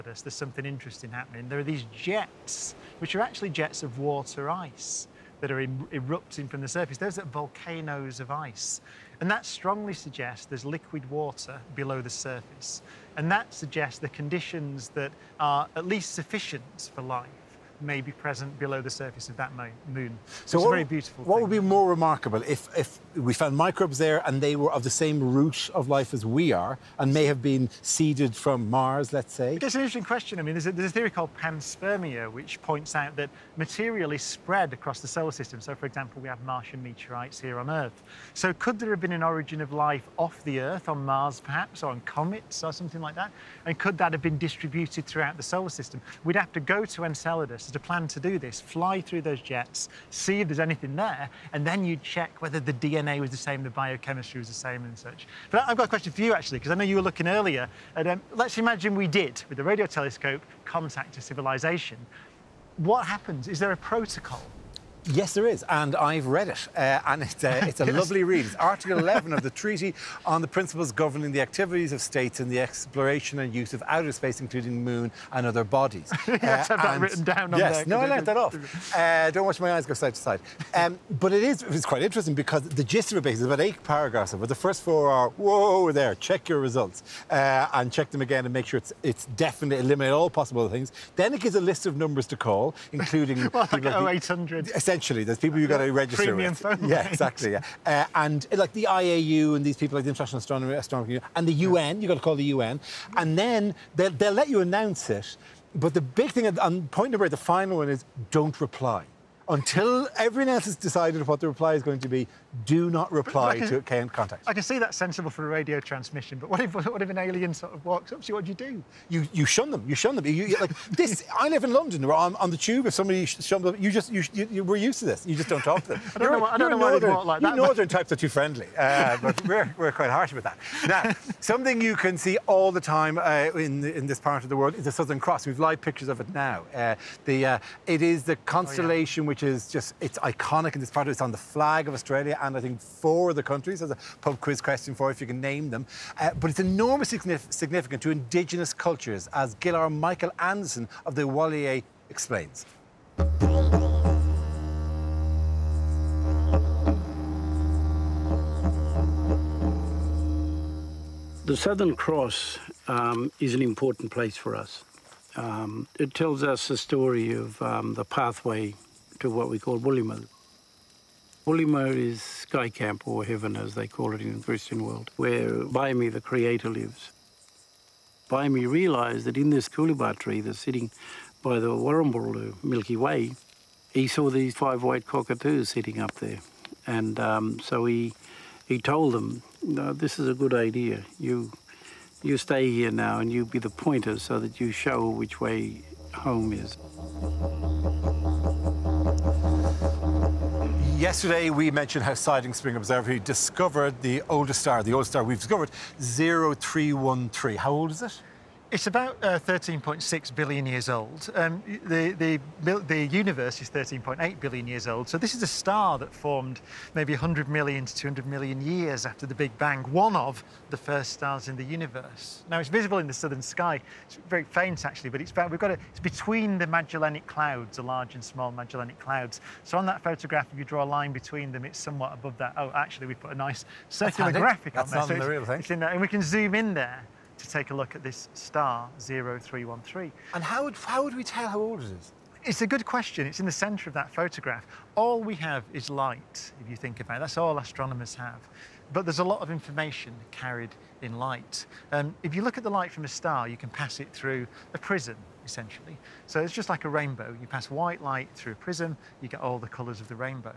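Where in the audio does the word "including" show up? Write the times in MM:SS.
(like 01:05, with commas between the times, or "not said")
01:14, 01:32.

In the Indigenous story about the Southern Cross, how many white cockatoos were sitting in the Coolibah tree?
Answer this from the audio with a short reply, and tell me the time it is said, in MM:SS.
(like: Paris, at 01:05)
5, at 03:04.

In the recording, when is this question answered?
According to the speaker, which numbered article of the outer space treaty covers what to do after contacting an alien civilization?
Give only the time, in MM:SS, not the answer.
01:08.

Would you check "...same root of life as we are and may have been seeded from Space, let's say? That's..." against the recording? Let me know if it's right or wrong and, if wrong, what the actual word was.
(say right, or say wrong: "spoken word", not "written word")
wrong: "Mars", not "Space".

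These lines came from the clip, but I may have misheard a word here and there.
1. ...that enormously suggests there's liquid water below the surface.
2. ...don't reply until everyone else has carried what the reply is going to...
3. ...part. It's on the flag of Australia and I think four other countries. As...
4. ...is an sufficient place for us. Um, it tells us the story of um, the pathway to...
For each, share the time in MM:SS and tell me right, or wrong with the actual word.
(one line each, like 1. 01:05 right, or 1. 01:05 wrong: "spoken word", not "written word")
1. 00:09 wrong: "strongly", not "enormously"
2. 01:48 wrong: "decided", not "carried"
3. 02:20 right
4. 02:43 wrong: "important", not "sufficient".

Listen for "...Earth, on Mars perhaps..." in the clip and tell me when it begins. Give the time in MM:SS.
00:40.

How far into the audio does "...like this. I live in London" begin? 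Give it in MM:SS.
02:00.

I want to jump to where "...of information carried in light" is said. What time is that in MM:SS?
04:09.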